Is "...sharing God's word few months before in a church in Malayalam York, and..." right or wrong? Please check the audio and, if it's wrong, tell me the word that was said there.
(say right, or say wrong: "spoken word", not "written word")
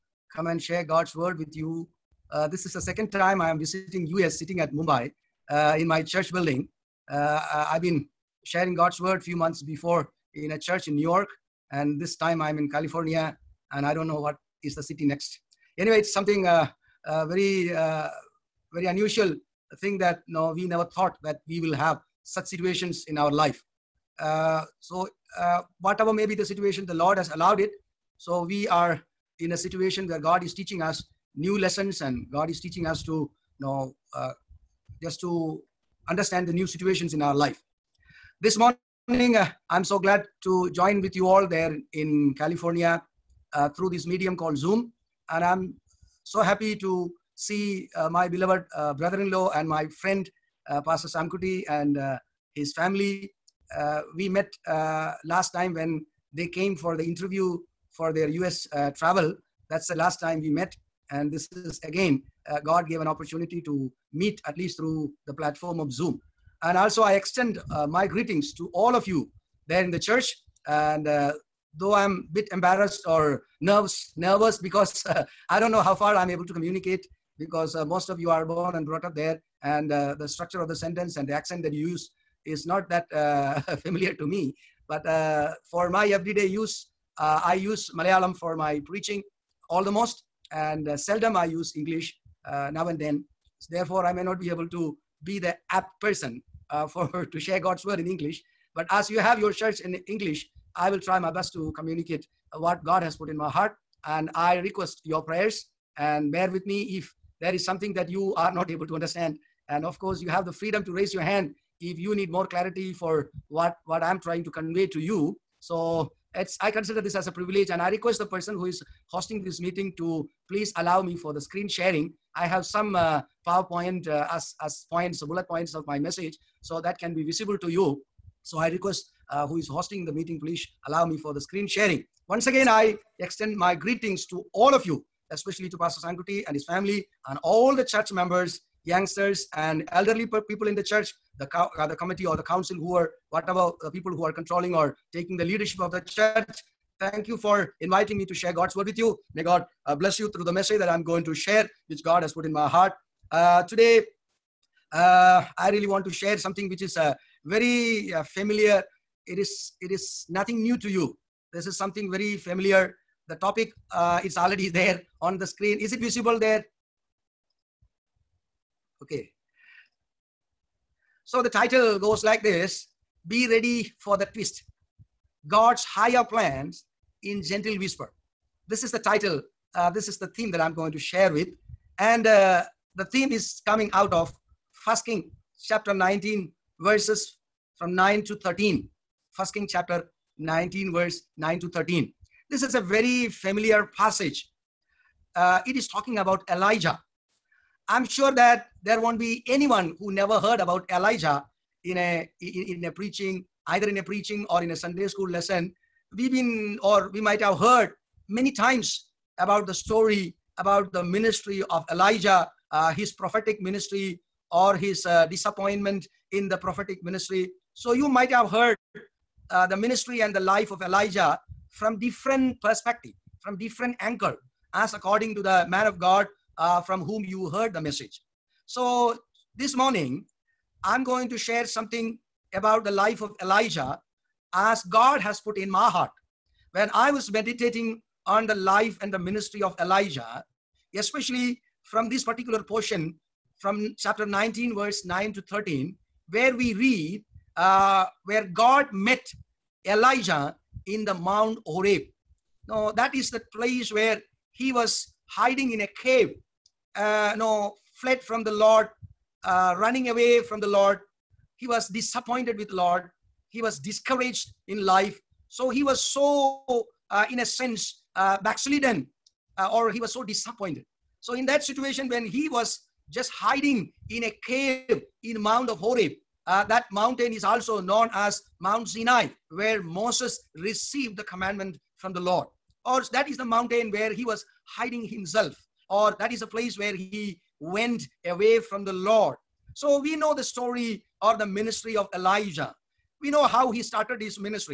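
wrong: "New", not "Malayalam".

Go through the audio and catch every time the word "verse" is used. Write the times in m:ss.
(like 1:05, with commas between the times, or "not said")
3:06, 3:10, 4:04.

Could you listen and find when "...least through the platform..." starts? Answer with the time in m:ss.
1:04.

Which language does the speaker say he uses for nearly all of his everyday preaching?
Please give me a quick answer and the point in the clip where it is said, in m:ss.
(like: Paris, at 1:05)
Malayalam, at 1:27.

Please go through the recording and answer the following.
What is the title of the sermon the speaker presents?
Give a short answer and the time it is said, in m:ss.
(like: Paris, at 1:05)
Be ready for the twist, at 2:53.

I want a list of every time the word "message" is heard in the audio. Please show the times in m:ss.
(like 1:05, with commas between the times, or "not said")
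2:05, 2:30, 3:47.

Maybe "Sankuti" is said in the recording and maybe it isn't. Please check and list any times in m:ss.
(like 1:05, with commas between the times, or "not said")
2:16.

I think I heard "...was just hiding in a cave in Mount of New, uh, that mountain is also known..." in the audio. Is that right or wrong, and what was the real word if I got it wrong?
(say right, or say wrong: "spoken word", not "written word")
wrong: "Horeb", not "New".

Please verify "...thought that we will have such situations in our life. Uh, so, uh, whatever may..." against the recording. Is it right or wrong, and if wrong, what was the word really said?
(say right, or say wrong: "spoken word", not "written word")
right.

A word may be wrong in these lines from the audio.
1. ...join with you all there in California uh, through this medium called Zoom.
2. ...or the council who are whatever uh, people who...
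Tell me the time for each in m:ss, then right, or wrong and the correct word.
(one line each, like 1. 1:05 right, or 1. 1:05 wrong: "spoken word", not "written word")
1. 0:40 right
2. 2:22 right.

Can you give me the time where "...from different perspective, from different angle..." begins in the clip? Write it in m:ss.
3:41.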